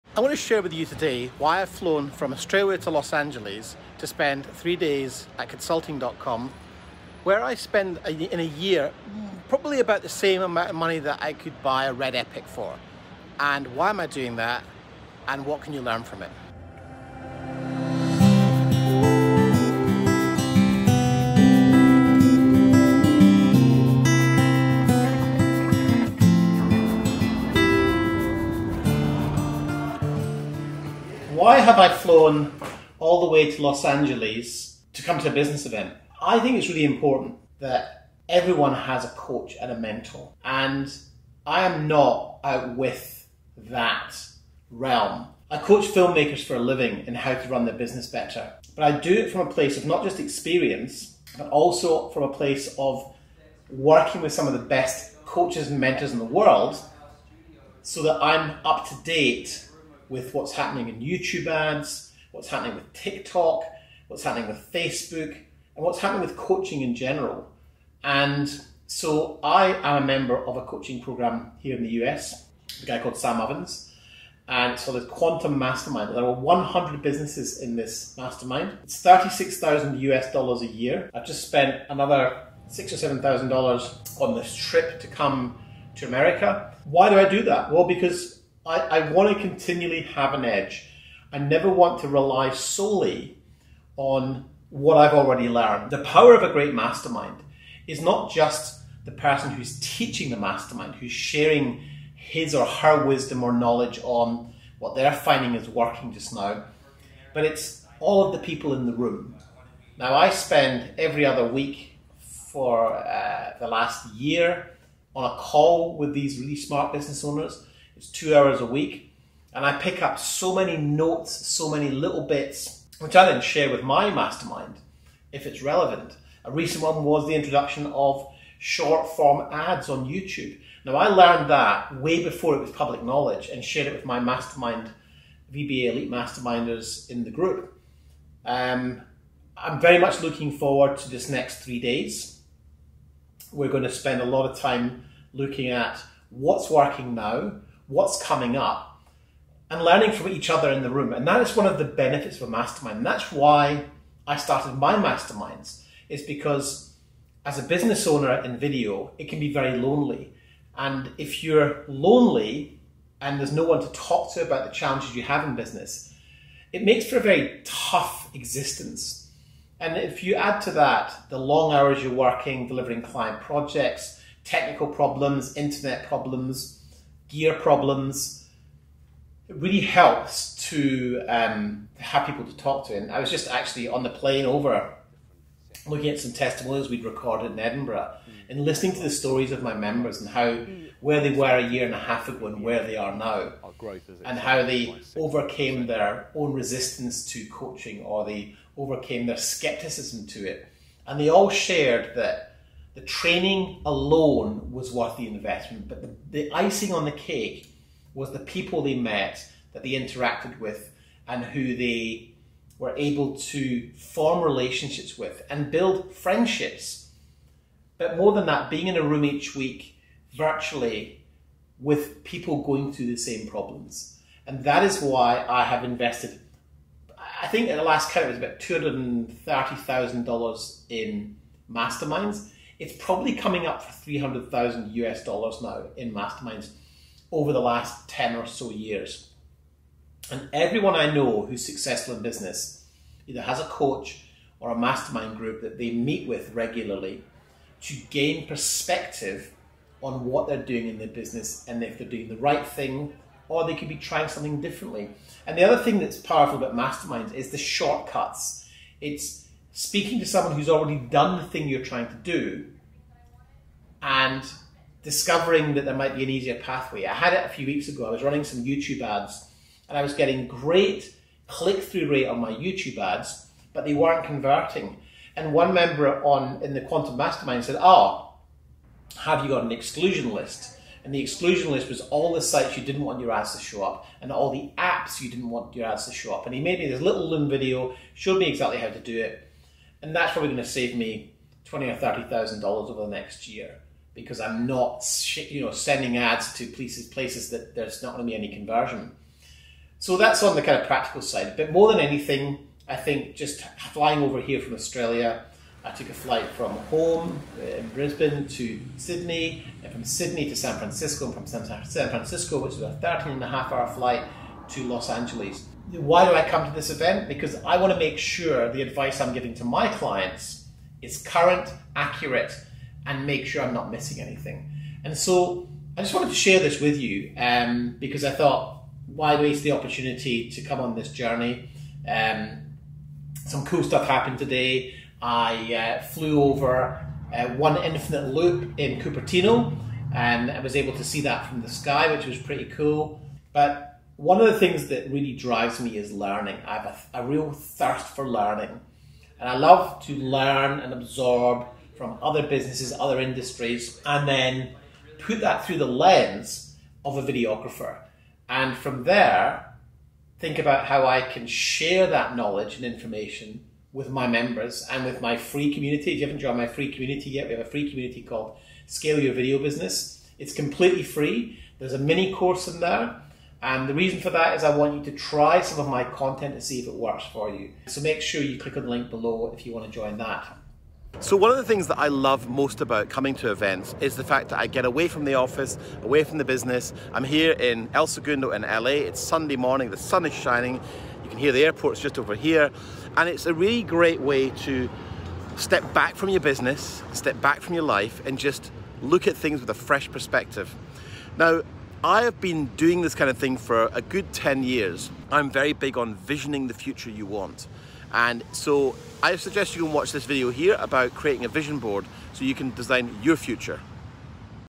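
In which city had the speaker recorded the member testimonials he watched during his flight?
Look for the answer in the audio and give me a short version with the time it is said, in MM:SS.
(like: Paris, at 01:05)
Edinburgh, at 03:07.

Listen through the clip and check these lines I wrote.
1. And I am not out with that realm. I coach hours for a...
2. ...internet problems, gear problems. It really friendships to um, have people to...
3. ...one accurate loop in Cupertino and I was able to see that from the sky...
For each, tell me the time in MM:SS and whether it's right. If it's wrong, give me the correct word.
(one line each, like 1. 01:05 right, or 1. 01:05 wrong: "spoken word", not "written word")
1. 00:40 wrong: "filmmakers", not "hours"
2. 02:55 wrong: "helps", not "friendships"
3. 05:37 wrong: "infinite", not "accurate".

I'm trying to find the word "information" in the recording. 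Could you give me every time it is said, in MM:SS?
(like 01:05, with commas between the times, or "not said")
06:02.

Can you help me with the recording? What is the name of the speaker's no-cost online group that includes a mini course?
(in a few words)
Scale Your Video Business.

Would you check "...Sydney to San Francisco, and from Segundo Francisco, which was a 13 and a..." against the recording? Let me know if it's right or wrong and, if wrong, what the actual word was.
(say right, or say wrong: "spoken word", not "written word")
wrong: "San", not "Segundo".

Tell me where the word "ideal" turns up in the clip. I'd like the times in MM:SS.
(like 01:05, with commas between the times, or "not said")
not said.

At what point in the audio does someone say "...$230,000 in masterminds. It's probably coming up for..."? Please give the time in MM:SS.
03:48.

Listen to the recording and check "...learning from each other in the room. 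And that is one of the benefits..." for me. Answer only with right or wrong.
right.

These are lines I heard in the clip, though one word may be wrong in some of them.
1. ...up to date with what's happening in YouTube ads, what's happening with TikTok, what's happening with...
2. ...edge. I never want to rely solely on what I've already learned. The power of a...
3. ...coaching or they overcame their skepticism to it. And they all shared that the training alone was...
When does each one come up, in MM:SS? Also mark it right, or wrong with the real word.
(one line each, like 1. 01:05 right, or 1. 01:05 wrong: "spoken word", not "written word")
1. 00:58 right
2. 01:30 right
3. 03:17 right.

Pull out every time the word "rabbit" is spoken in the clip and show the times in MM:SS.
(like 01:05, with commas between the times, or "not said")
not said.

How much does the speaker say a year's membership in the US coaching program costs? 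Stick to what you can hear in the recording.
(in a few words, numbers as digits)
$36,000.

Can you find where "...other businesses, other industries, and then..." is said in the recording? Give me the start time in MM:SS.
05:52.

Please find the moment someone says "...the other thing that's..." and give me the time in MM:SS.
04:15.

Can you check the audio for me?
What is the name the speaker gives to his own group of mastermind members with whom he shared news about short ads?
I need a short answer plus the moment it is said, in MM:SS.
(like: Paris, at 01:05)
VBA Elite, at 02:15.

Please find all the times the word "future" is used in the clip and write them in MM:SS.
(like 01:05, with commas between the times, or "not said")
06:46, 06:53.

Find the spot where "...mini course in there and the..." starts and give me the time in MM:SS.
06:11.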